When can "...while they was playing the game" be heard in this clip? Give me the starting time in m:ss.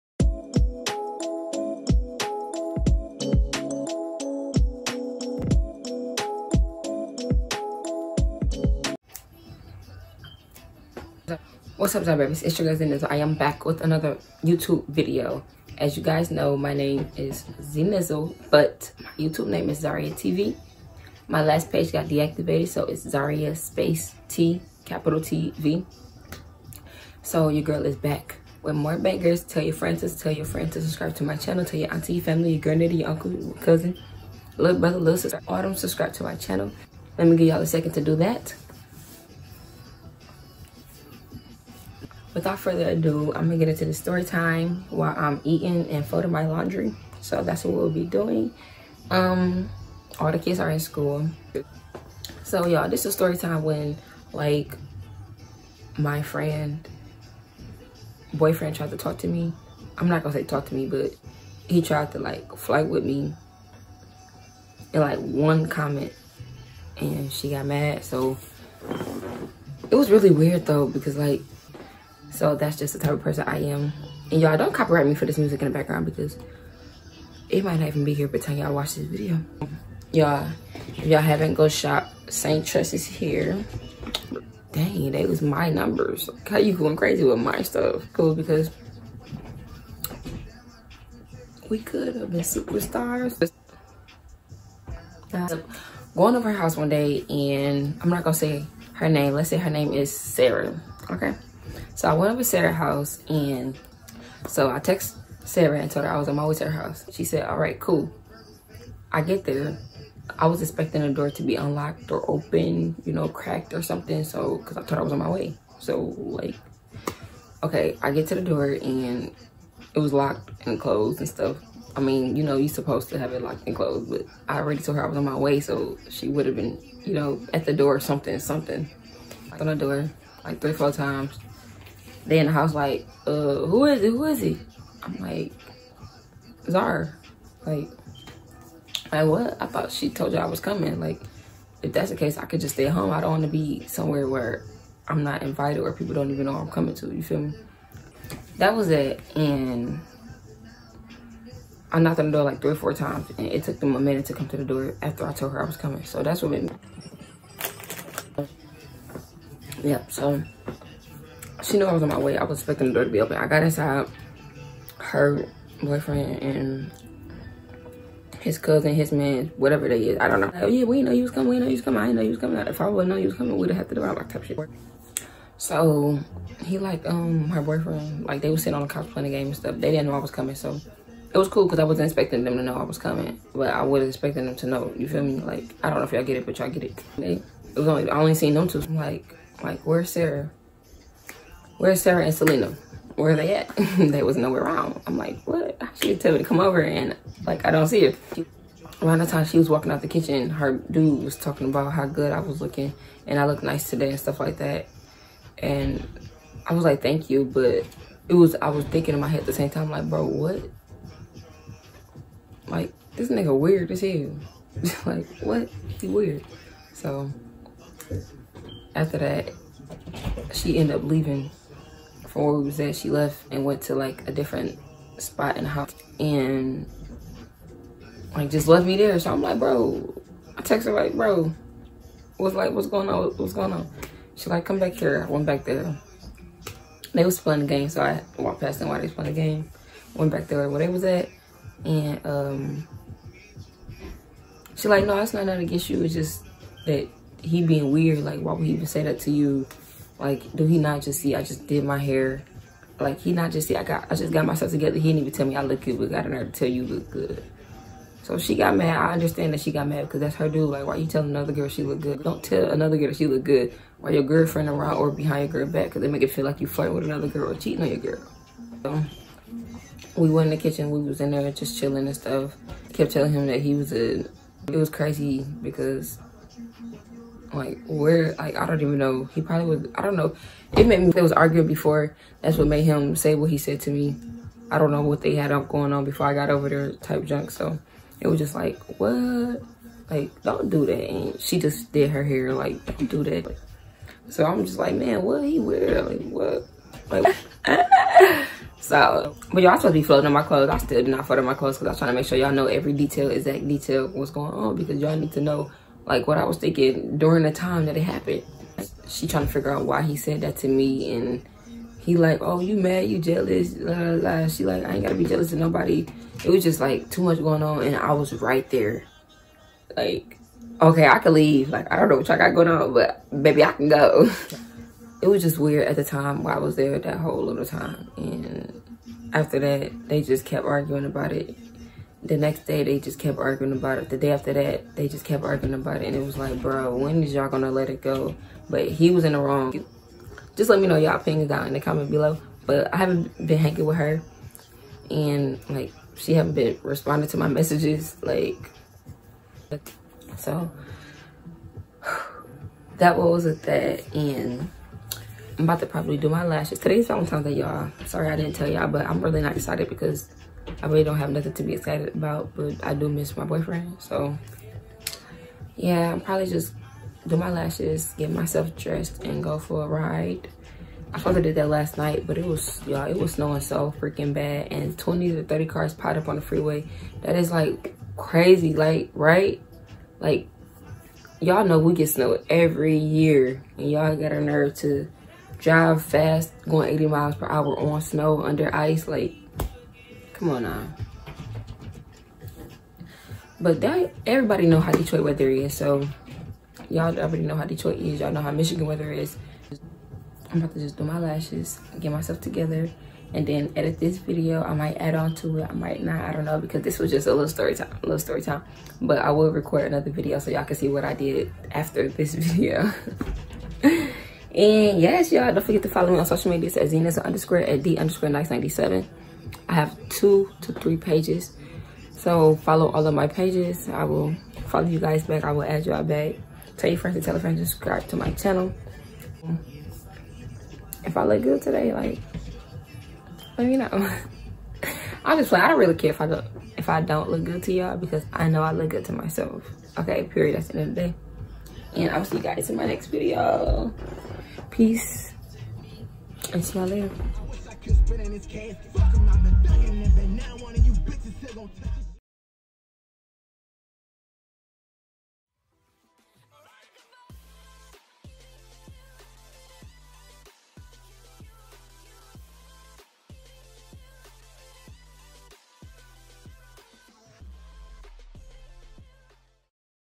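3:58.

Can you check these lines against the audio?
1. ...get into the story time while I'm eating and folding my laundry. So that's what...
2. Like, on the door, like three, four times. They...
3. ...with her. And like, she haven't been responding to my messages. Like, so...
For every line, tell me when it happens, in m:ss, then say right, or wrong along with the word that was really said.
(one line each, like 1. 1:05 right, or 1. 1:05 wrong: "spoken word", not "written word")
1. 0:43 right
2. 2:09 right
3. 5:43 right.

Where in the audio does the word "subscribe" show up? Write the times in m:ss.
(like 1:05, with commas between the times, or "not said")
0:30, 0:35, 7:07.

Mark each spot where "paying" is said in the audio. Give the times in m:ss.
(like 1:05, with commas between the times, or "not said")
not said.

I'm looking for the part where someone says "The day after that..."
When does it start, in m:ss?
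5:34.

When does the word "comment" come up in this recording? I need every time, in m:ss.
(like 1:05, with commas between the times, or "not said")
1:05, 5:41.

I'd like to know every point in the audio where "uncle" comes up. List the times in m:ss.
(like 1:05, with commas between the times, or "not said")
0:33.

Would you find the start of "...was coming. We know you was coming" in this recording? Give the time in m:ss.
2:51.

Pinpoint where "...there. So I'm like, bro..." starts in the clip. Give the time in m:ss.
3:48.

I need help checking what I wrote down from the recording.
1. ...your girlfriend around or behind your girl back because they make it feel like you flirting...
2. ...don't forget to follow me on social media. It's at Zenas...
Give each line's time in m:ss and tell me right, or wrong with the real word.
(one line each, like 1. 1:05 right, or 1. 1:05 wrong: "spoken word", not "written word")
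1. 4:24 right
2. 6:55 right.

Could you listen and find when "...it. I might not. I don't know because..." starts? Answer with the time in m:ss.
6:45.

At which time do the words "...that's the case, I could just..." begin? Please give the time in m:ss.
2:21.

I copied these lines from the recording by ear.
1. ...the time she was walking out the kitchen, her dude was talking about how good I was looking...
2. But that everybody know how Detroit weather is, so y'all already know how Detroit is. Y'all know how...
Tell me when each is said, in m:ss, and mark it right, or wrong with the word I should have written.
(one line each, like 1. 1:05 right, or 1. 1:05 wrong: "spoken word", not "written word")
1. 3:19 right
2. 6:33 right.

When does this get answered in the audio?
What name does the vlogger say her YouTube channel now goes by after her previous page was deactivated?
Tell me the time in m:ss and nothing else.
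0:19.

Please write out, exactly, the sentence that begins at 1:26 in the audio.
How you going crazy with my stuff?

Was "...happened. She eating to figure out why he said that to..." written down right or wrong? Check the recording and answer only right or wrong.
wrong.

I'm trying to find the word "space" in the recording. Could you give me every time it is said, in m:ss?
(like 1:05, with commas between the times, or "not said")
0:23.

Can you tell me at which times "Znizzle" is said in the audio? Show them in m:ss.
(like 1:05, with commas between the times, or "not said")
0:12, 0:17.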